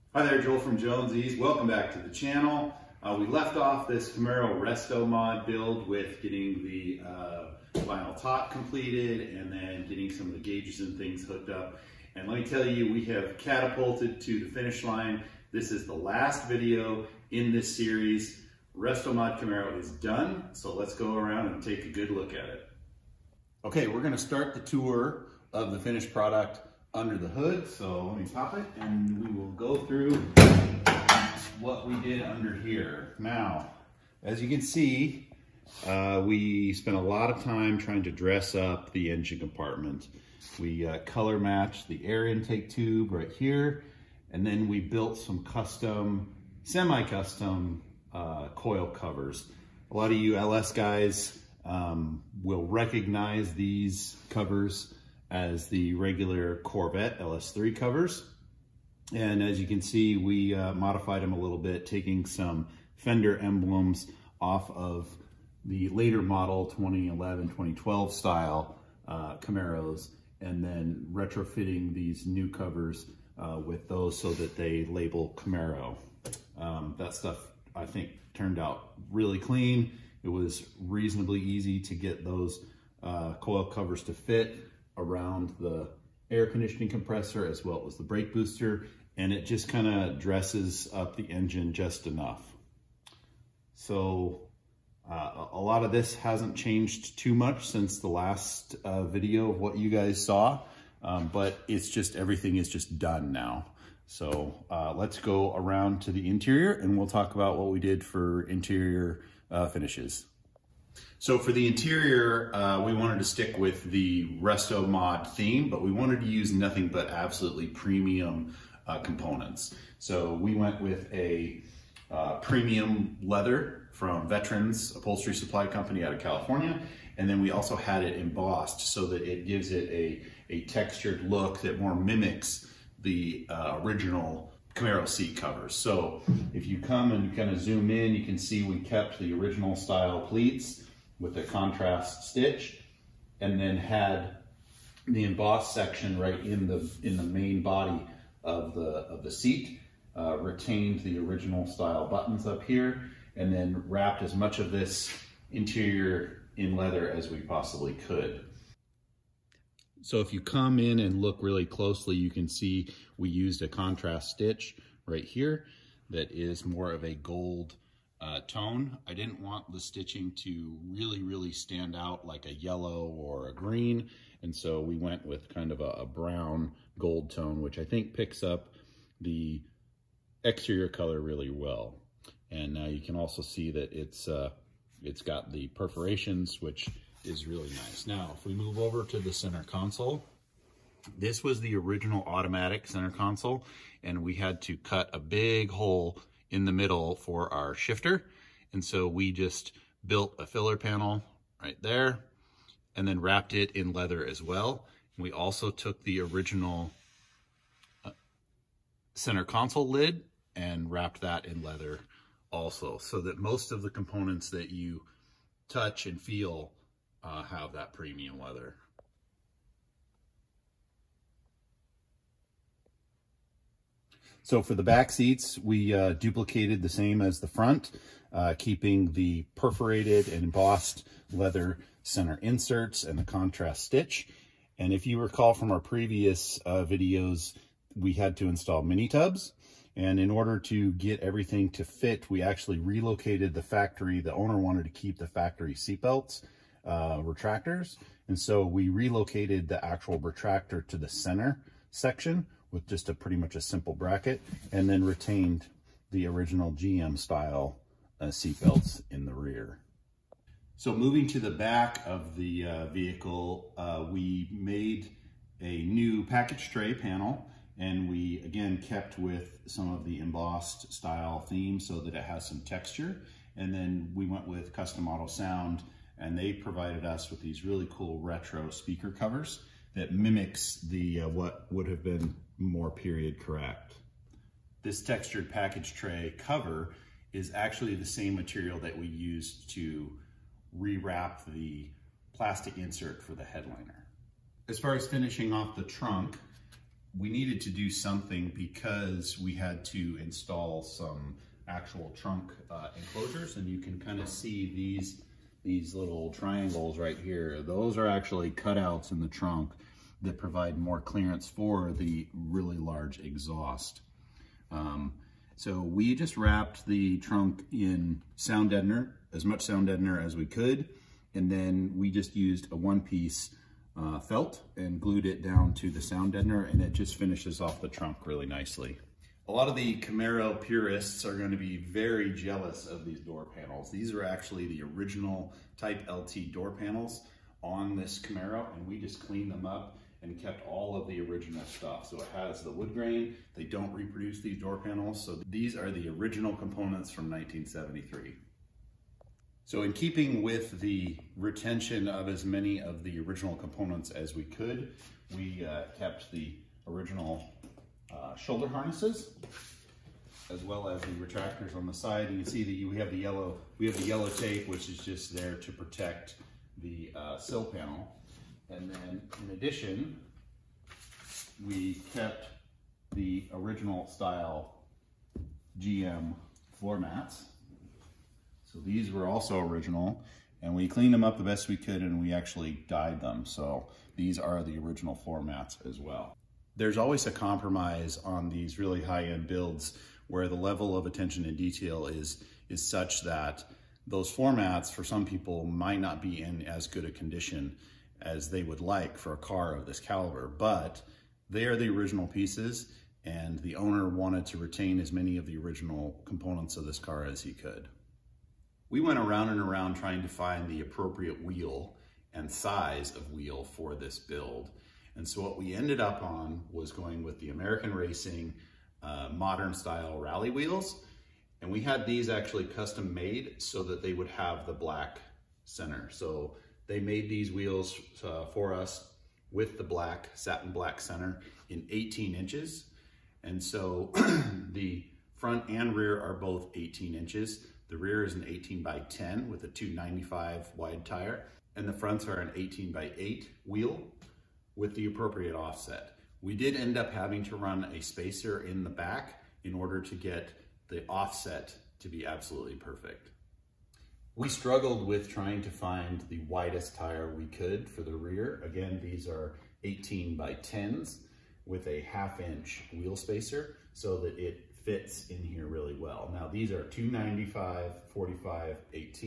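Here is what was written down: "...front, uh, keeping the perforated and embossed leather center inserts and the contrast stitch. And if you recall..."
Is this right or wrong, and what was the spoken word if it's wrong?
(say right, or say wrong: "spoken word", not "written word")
right.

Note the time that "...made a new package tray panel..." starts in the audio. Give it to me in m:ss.
4:24.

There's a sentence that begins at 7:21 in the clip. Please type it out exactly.
And the fronts are an 18 by 8 wheel with the appropriate offset.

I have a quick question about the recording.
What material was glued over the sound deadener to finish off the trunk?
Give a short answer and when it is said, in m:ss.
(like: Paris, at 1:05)
felt, at 5:24.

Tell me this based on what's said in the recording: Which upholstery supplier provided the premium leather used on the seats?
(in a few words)
Veterans Upholstery Supply Company.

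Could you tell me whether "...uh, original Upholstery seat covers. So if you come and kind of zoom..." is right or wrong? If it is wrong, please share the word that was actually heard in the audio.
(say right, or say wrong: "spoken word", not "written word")
wrong: "Camaro", not "Upholstery".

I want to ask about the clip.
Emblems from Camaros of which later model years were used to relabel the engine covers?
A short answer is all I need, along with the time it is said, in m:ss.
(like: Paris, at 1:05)
2011, 2012, at 1:06.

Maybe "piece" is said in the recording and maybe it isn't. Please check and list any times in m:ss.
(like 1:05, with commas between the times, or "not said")
5:22, 6:42.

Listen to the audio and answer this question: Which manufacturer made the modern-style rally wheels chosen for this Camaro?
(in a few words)
American Racing.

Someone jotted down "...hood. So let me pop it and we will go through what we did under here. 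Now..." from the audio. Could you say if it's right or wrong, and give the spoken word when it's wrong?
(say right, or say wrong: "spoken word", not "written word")
right.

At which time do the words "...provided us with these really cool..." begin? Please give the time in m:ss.
4:36.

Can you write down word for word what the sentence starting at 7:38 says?
Again, these are 18 by 10s with a half inch wheel spacer so that it fits in here really well.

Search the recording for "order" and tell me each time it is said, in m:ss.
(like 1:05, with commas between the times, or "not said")
4:00, 7:29.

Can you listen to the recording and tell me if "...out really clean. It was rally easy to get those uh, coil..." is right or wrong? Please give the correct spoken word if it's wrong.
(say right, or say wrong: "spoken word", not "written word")
wrong: "reasonably", not "rally".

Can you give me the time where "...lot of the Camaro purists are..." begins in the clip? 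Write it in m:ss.
5:29.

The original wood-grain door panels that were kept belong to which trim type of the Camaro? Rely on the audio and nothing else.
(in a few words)
Type LT.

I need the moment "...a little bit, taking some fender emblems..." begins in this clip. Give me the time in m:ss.
1:01.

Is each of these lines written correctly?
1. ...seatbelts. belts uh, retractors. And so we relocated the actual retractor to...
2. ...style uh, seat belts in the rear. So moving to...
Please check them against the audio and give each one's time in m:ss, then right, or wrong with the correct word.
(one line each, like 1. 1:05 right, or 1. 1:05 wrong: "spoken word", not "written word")
1. 4:05 right
2. 4:17 right.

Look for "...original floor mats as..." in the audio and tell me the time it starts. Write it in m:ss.
6:24.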